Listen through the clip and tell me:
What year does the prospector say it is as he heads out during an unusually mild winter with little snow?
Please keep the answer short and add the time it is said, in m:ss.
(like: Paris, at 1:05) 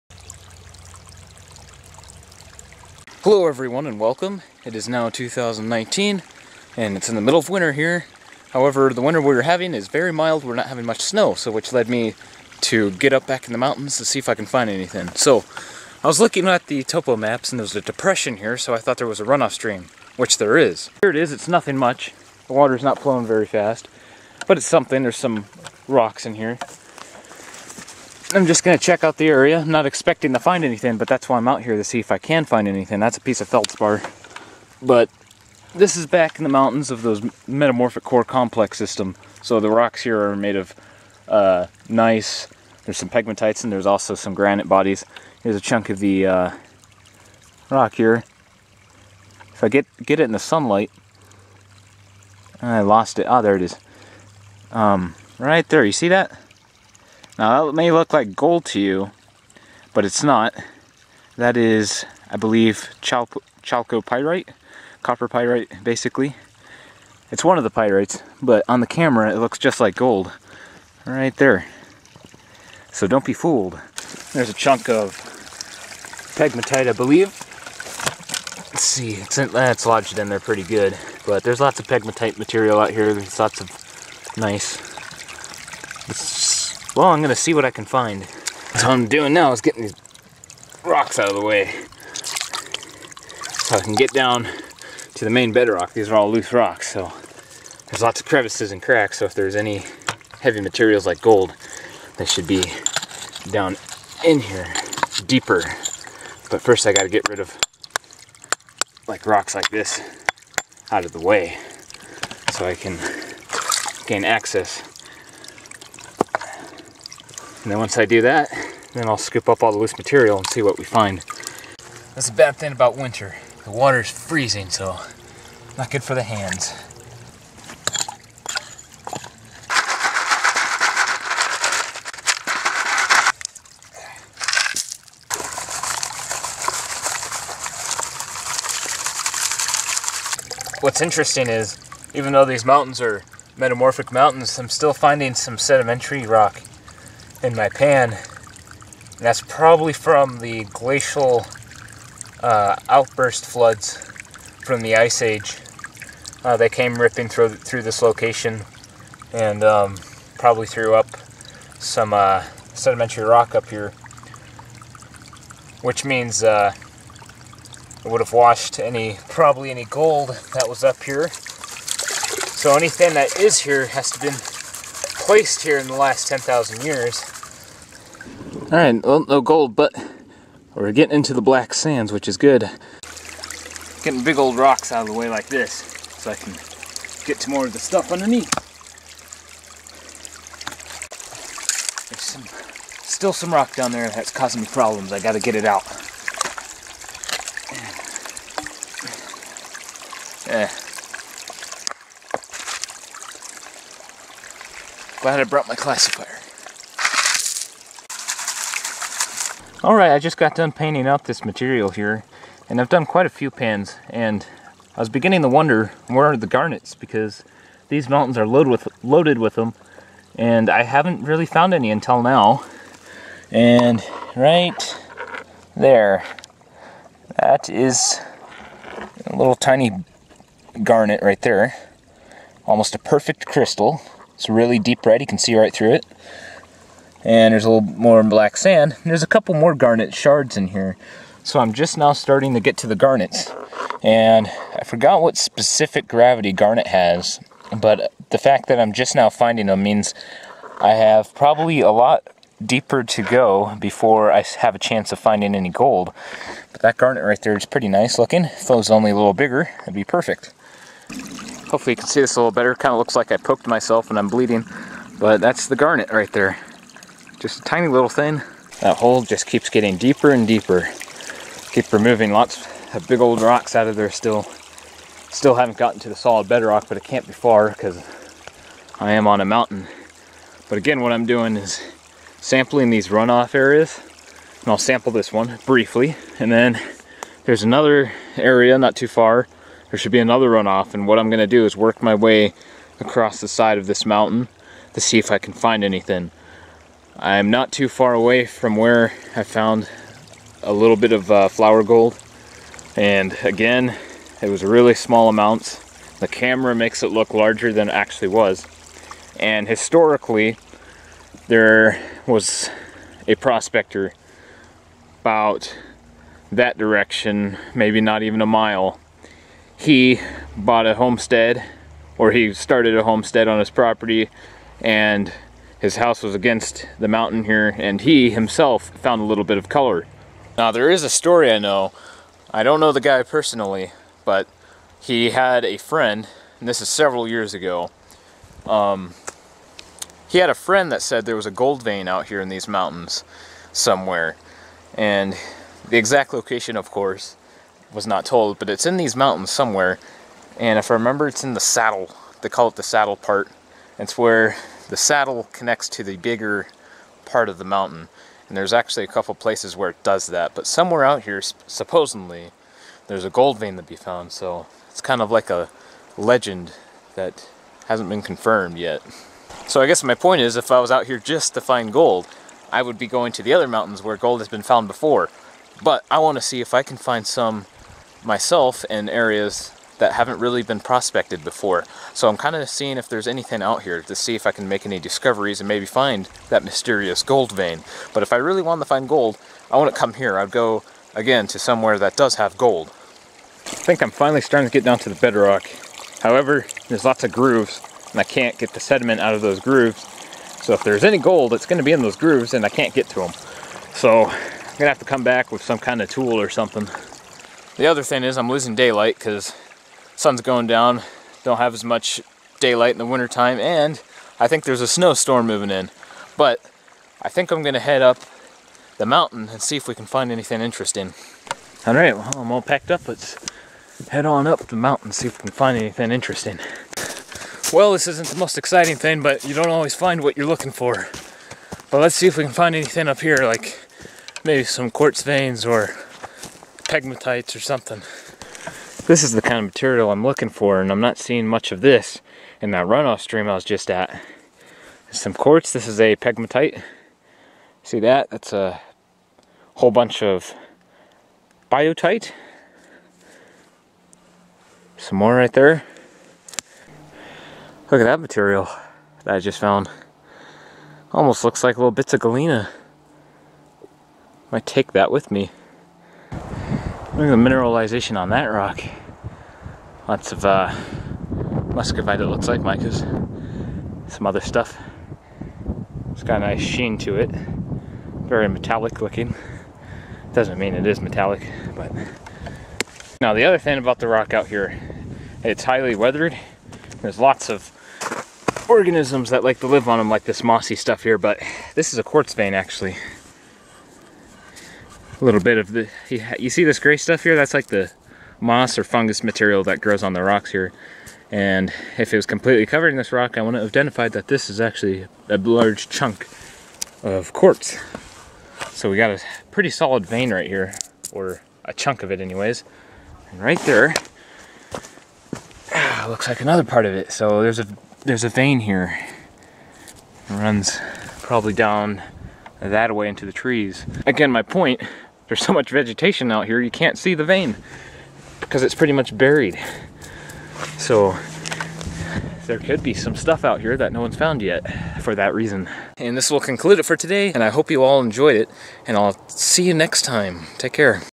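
2019, at 0:05.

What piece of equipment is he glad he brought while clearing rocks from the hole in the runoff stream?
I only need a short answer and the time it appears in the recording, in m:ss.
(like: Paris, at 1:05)
Classifier, at 3:25.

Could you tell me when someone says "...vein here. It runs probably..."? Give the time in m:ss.
8:38.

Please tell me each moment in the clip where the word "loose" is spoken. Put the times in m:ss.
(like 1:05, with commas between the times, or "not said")
1:36, 1:59.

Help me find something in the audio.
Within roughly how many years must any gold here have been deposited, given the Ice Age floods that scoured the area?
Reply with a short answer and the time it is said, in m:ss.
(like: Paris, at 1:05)
10,000 years, at 2:56.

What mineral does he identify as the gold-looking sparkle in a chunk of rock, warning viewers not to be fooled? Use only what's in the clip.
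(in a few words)
Chalcopyrite.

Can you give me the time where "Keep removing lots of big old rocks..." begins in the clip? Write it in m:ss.
4:31.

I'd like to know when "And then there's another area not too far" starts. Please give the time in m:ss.
4:46.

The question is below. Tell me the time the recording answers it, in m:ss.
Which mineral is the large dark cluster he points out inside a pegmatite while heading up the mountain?
7:31.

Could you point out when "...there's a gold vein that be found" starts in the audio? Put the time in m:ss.
6:03.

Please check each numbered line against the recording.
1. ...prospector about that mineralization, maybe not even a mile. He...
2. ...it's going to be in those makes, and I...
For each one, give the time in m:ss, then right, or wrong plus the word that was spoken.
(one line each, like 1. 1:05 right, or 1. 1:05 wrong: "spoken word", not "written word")
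1. 5:13 wrong: "direction", not "mineralization"
2. 6:41 wrong: "grooves", not "makes".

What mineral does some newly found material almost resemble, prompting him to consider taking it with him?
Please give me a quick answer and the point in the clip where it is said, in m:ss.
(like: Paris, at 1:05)
Galena, at 7:42.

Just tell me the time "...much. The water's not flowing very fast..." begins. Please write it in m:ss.
0:21.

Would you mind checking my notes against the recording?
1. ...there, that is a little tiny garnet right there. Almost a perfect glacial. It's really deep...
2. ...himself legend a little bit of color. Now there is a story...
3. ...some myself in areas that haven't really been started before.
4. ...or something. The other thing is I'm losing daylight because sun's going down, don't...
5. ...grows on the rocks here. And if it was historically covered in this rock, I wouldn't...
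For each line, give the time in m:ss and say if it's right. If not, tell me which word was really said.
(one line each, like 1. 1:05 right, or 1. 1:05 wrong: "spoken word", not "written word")
1. 3:45 wrong: "crystal", not "glacial"
2. 5:28 wrong: "found", not "legend"
3. 6:17 wrong: "prospected", not "started"
4. 6:46 right
5. 8:19 wrong: "completely", not "historically".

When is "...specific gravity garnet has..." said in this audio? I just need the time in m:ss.
4:05.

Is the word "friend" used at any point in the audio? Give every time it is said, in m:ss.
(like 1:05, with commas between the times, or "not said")
5:35, 5:40.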